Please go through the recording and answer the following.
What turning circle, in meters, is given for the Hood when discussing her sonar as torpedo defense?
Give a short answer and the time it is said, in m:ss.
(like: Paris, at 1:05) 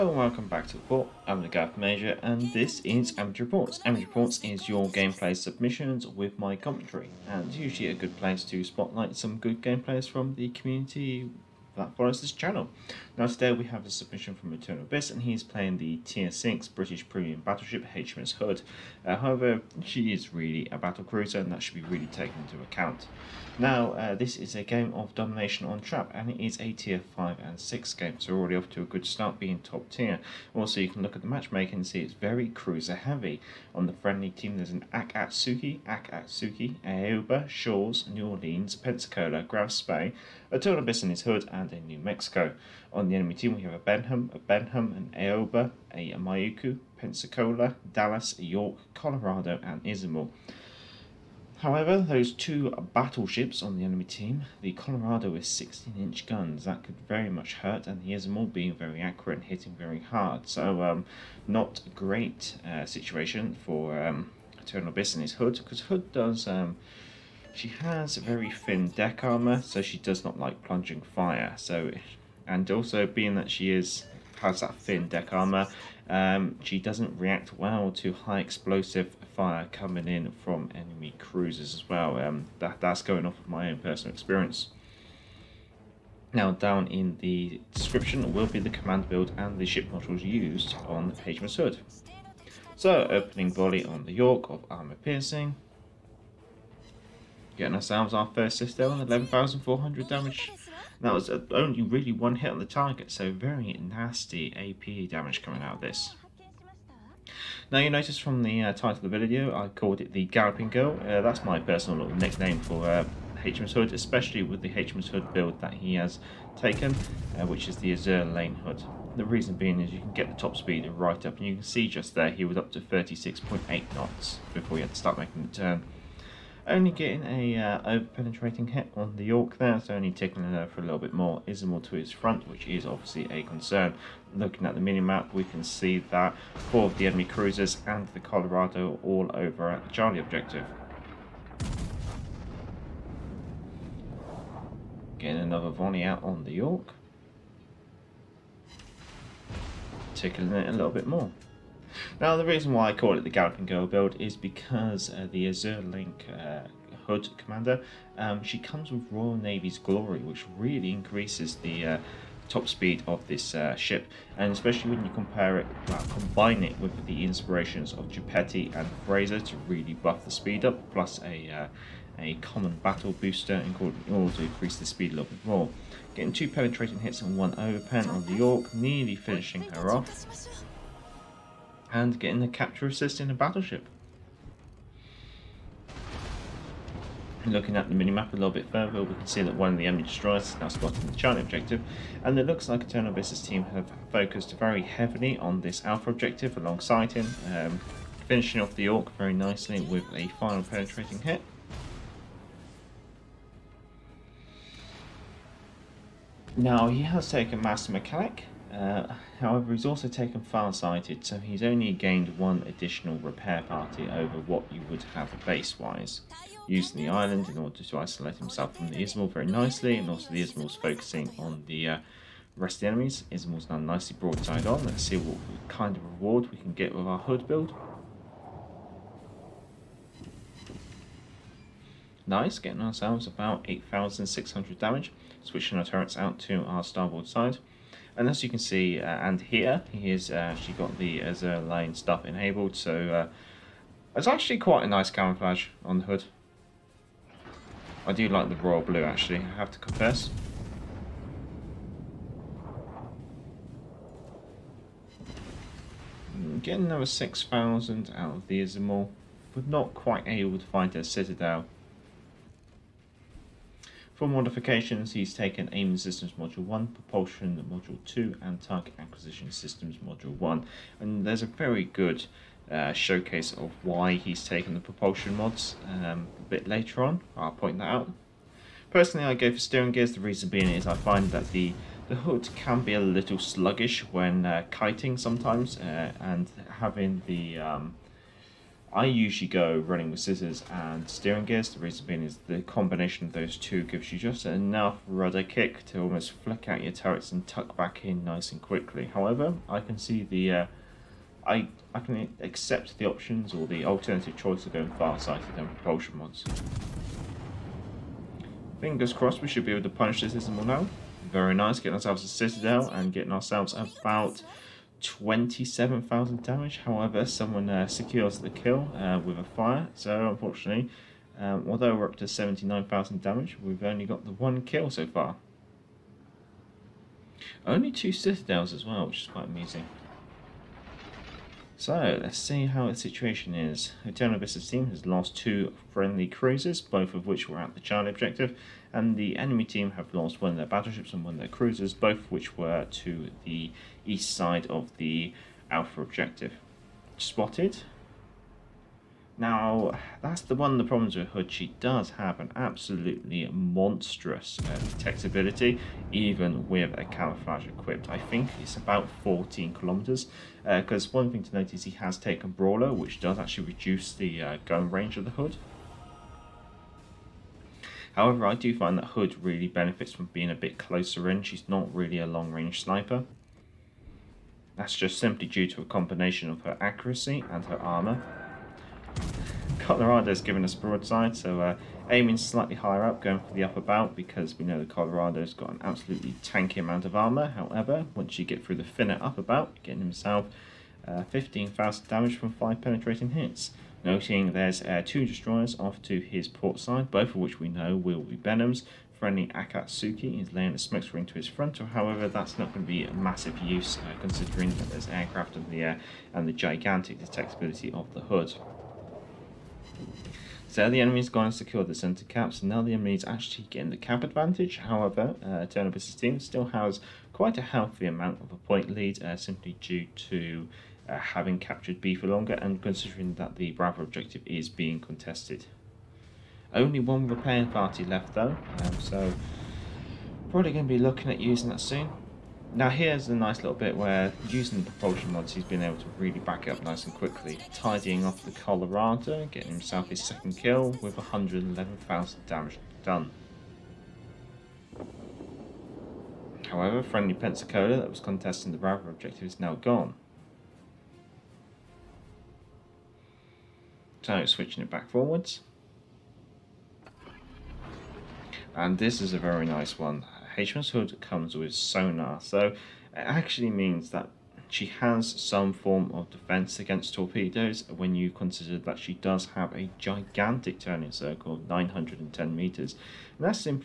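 910 meters, at 7:51.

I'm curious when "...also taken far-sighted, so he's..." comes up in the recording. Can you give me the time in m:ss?
3:29.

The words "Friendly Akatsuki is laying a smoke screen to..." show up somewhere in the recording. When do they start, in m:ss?
6:39.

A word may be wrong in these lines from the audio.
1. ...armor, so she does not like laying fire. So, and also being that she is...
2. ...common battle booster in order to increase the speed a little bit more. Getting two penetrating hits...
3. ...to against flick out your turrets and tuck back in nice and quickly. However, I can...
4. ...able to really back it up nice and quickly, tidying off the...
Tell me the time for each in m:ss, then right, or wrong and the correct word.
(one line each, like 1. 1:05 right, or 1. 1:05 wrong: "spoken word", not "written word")
1. 1:09 wrong: "plunging", not "laying"
2. 2:52 right
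3. 4:55 wrong: "almost", not "against"
4. 7:15 right.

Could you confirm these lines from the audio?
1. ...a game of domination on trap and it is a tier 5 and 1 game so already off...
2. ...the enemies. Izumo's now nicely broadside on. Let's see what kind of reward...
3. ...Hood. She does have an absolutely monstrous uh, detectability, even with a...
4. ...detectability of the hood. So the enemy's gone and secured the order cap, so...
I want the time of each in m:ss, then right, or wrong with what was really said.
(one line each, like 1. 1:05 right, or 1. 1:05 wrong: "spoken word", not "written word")
1. 0:24 wrong: "6", not "1"
2. 3:42 right
3. 5:51 right
4. 6:47 wrong: "center", not "order".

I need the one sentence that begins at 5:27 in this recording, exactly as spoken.
Only two citadels as well, which is quite amusing.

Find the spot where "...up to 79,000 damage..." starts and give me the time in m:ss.
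5:22.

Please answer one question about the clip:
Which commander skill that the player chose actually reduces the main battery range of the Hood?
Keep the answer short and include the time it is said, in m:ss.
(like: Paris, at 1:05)
Brawler, at 6:02.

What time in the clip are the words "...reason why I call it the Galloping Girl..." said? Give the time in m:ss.
2:32.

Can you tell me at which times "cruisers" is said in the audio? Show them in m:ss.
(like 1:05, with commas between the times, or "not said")
0:21, 0:32, 1:21, 2:17, 5:36, 5:41.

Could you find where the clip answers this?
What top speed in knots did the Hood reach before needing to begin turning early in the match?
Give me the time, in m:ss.
2:02.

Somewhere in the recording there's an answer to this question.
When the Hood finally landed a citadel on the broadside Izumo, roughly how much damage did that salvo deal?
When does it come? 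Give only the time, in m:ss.
5:15.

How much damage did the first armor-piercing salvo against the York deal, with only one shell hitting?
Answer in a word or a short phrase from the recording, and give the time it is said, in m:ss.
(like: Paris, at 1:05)
11,400, at 1:39.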